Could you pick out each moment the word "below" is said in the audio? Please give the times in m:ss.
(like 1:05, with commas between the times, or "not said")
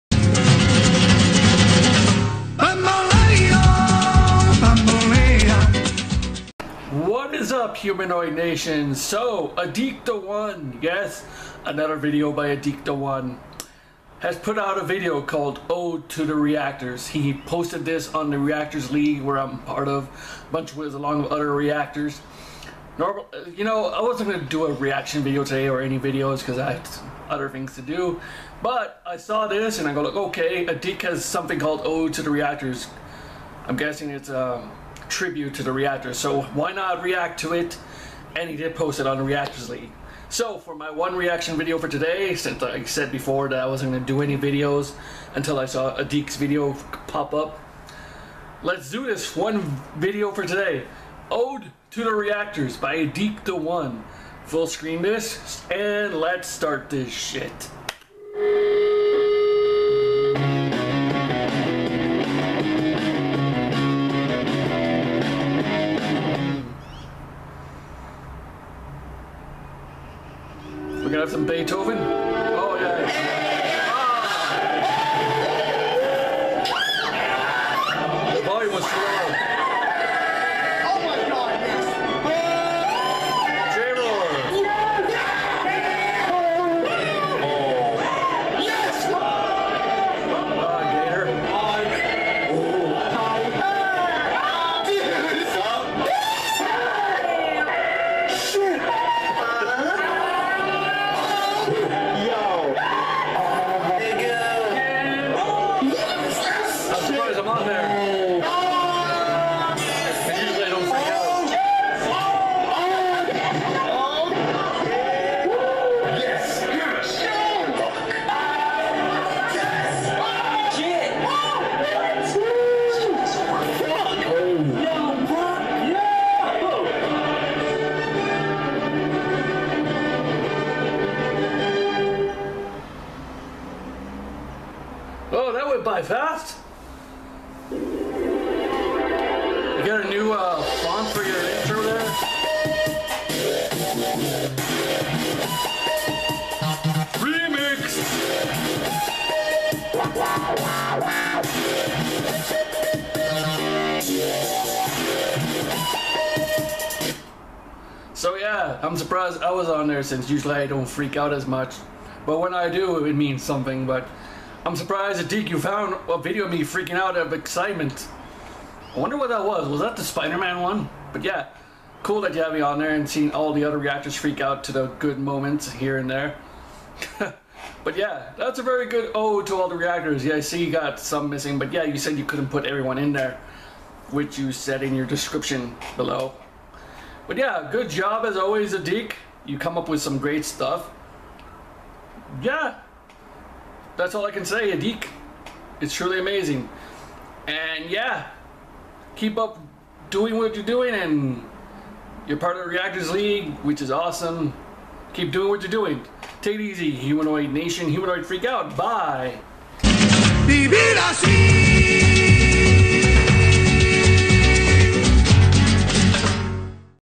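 3:05.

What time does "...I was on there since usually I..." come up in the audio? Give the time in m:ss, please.
2:39.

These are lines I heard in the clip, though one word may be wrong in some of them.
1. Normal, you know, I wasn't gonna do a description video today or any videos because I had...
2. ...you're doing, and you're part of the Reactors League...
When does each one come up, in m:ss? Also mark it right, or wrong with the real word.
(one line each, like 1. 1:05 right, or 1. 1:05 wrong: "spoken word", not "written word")
1. 0:22 wrong: "reaction", not "description"
2. 3:20 right.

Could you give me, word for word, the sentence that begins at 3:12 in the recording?
Yeah, that's all I can say.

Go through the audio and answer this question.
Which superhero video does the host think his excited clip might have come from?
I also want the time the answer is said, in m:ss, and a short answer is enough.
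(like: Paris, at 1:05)
Spider-Man, at 2:50.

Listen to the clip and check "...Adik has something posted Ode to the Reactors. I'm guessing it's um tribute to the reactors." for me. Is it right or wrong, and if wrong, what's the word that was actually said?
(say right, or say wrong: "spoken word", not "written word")
wrong: "called", not "posted".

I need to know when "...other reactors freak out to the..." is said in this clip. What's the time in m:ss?
2:53.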